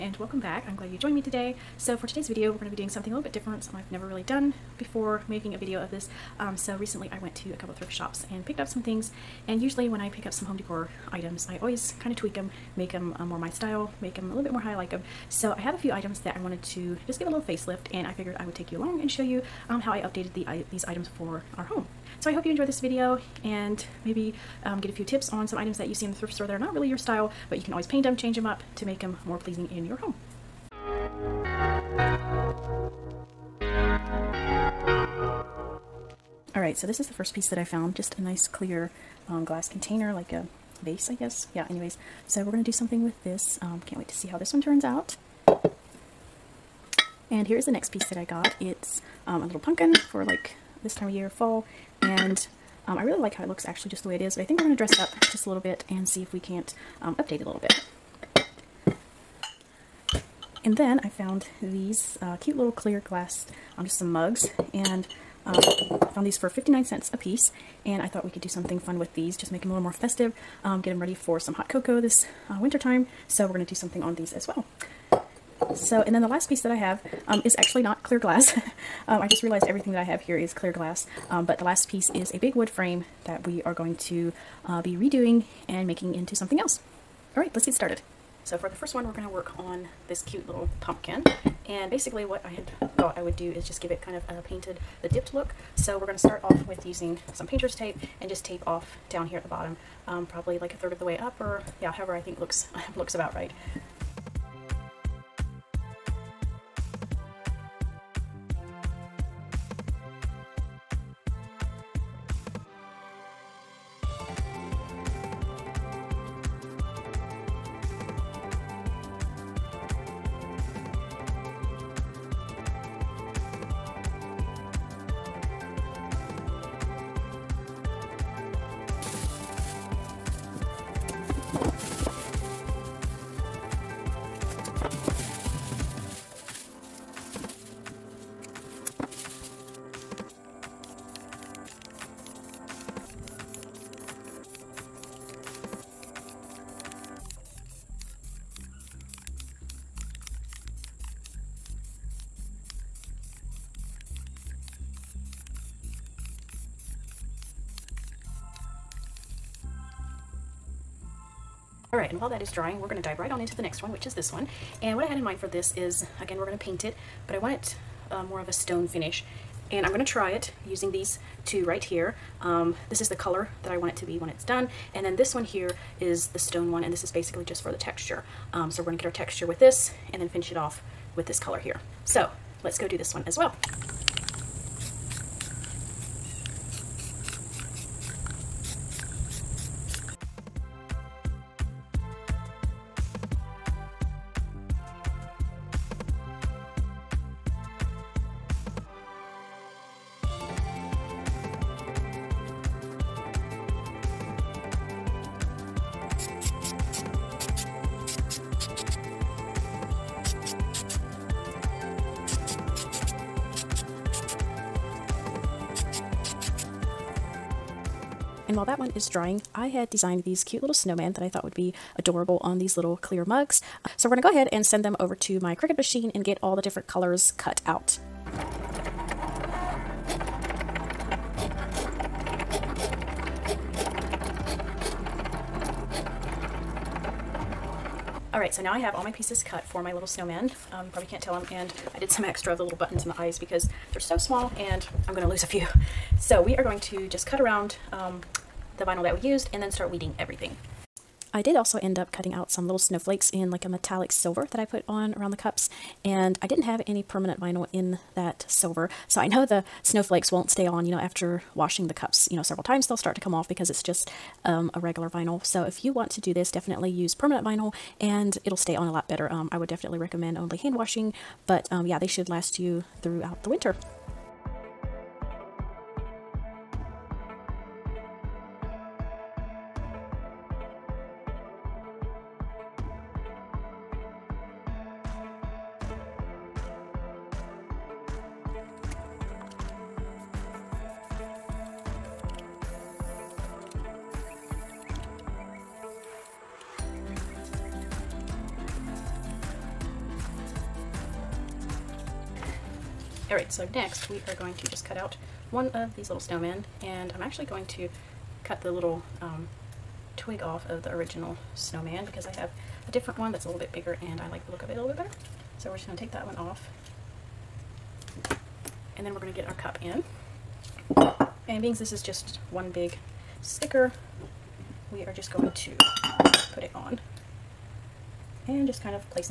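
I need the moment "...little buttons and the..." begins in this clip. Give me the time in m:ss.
4:02.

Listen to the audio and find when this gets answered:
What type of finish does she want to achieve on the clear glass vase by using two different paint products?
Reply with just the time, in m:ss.
2:48.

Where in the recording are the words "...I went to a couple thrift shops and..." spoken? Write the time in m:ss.
0:07.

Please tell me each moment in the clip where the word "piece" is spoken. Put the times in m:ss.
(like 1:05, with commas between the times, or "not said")
0:37, 0:47, 1:07, 1:16, 1:21, 3:59.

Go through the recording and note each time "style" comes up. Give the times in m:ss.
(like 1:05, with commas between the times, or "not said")
0:13, 0:26.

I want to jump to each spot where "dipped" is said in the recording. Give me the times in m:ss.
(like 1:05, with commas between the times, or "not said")
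1:35.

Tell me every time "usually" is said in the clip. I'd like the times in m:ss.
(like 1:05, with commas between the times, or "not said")
0:09.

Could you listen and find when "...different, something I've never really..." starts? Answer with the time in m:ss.
0:03.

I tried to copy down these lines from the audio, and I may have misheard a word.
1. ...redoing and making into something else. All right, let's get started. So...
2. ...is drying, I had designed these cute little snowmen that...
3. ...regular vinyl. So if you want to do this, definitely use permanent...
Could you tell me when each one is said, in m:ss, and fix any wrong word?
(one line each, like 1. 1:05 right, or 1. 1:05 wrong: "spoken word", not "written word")
1. 1:24 right
2. 3:38 right
3. 4:24 right.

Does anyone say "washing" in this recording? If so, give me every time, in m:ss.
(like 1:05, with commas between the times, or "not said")
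4:21, 4:30.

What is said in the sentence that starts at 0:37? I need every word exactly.
Just a nice clear um, glass container, like a vase, I guess.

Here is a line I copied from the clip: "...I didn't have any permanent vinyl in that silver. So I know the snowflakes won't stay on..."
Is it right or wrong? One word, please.
right.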